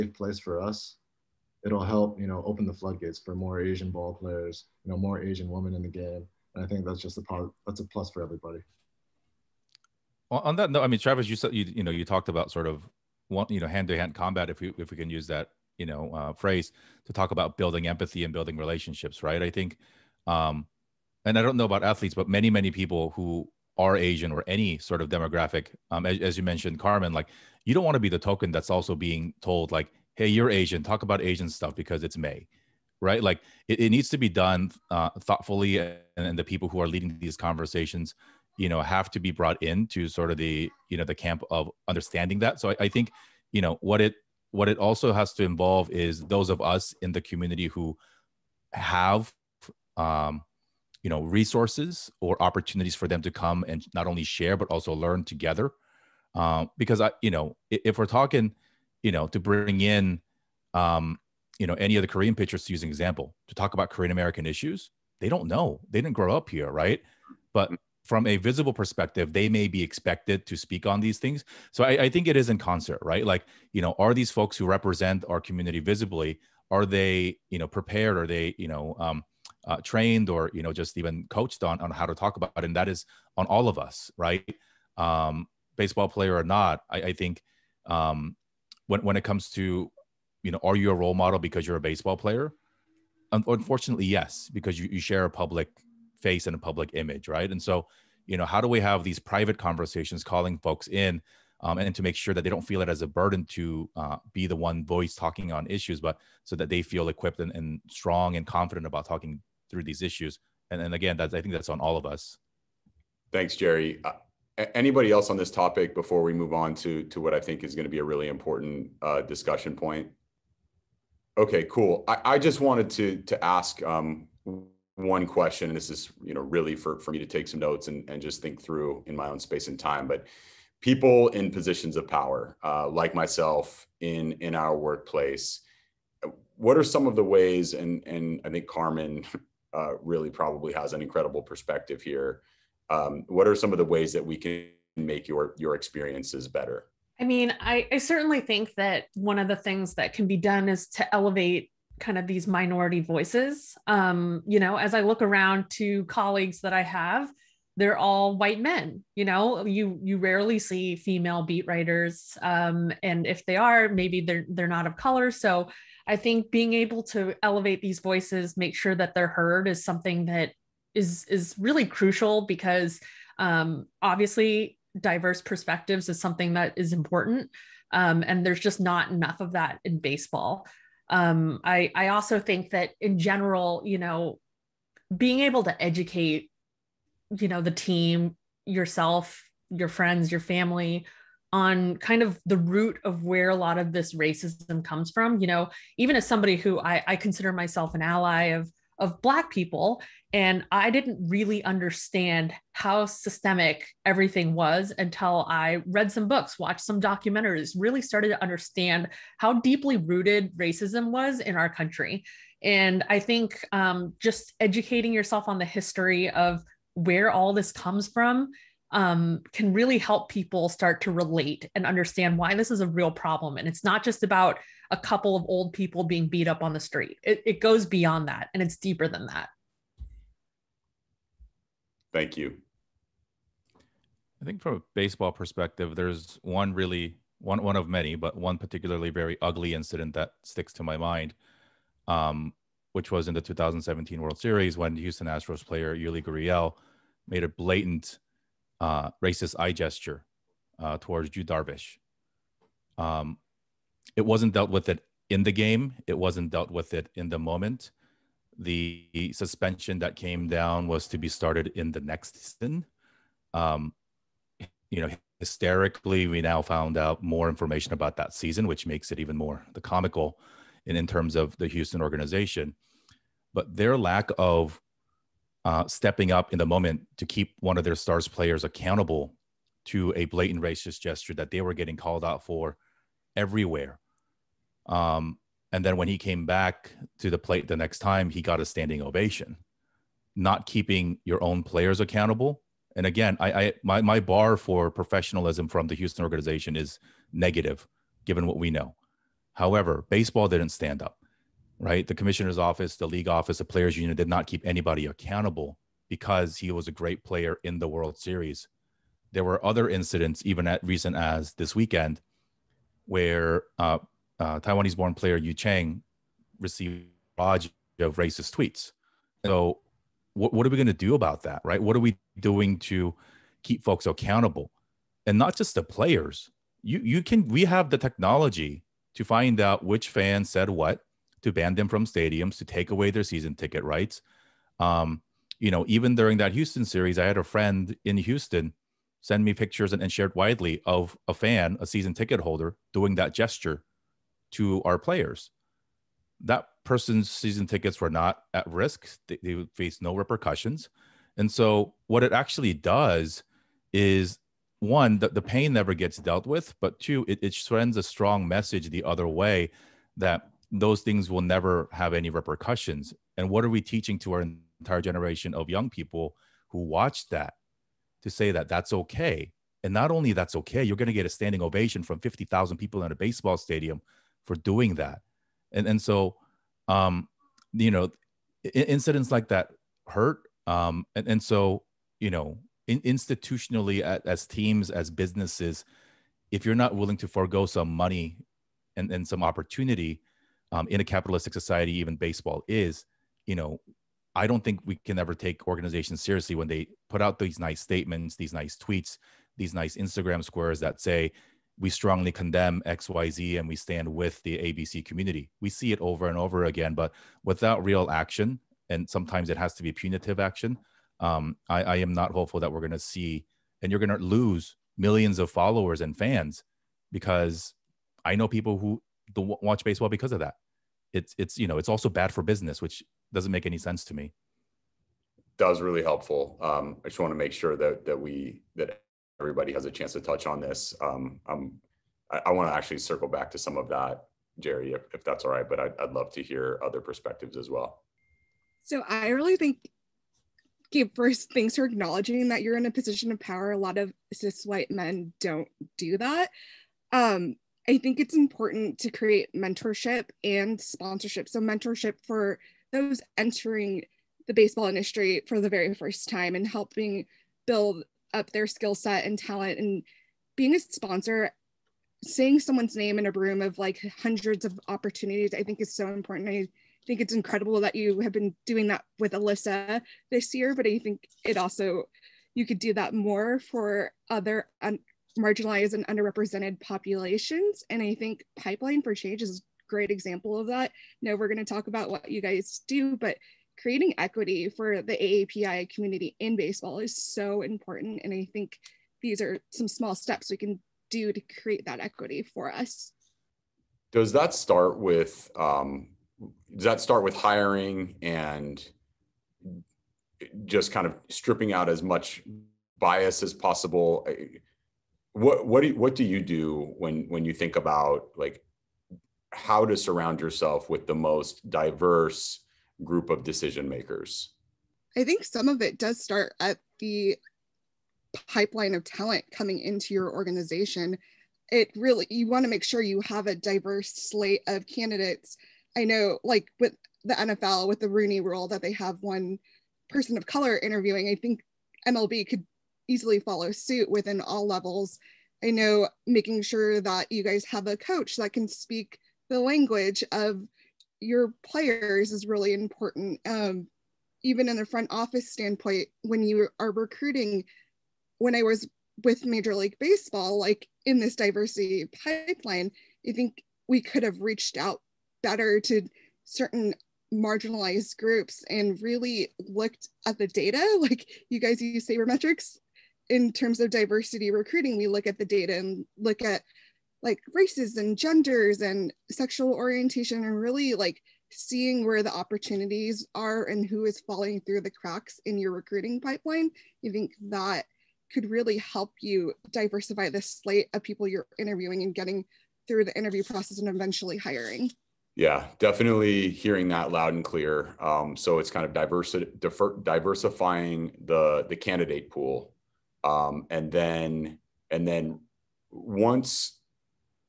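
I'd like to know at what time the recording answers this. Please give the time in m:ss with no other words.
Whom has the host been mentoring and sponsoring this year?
7:49.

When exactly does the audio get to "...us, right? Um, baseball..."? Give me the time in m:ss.
1:23.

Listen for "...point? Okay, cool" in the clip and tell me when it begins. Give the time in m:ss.
1:59.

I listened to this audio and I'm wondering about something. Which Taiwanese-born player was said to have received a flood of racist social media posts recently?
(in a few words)
Yu Chang.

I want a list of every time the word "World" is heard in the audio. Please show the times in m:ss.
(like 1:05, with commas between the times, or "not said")
4:04, 5:07.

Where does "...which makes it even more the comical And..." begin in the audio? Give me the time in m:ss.
4:28.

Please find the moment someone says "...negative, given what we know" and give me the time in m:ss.
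4:57.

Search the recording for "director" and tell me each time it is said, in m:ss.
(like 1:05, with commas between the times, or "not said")
not said.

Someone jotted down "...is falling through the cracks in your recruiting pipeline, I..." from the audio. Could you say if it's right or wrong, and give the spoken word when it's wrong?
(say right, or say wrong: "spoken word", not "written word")
right.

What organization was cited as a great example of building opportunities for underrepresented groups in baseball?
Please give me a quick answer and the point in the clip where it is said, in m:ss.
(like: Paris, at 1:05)
Pipeline for Change, at 7:58.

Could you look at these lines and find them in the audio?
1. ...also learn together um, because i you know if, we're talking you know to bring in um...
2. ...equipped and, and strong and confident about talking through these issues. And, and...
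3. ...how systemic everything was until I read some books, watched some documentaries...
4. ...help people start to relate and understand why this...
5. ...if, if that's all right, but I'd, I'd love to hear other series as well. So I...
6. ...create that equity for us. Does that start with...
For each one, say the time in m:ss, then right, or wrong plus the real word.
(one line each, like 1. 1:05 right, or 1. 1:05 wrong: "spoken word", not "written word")
1. 0:54 right
2. 1:47 right
3. 3:22 right
4. 3:39 right
5. 7:14 wrong: "perspectives", not "series"
6. 8:11 right.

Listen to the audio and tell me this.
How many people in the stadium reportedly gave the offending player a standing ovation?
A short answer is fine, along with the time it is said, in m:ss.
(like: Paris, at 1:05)
50,000, at 6:12.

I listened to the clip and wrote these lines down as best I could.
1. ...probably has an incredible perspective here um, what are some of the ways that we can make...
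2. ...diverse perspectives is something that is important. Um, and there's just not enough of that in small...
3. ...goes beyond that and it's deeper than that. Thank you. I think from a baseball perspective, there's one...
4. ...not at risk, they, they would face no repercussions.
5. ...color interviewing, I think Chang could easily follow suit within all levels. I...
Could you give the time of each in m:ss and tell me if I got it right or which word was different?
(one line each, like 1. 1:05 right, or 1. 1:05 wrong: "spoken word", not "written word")
1. 2:20 right
2. 2:54 wrong: "baseball", not "small"
3. 3:47 right
4. 5:48 right
5. 8:50 wrong: "MLB", not "Chang".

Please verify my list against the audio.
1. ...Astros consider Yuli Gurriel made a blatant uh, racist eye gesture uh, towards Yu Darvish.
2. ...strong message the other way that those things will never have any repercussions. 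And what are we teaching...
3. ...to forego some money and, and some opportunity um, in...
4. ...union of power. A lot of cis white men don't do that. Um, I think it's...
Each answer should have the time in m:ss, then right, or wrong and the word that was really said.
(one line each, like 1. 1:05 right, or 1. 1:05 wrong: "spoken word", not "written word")
1. 4:05 wrong: "player", not "consider"
2. 5:58 right
3. 6:27 right
4. 7:22 wrong: "position", not "union".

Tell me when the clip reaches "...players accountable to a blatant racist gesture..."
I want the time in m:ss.
4:38.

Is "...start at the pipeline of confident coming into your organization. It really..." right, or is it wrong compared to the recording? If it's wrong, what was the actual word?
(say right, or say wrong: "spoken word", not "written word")
wrong: "talent", not "confident".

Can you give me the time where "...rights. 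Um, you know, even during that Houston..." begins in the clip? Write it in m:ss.
5:33.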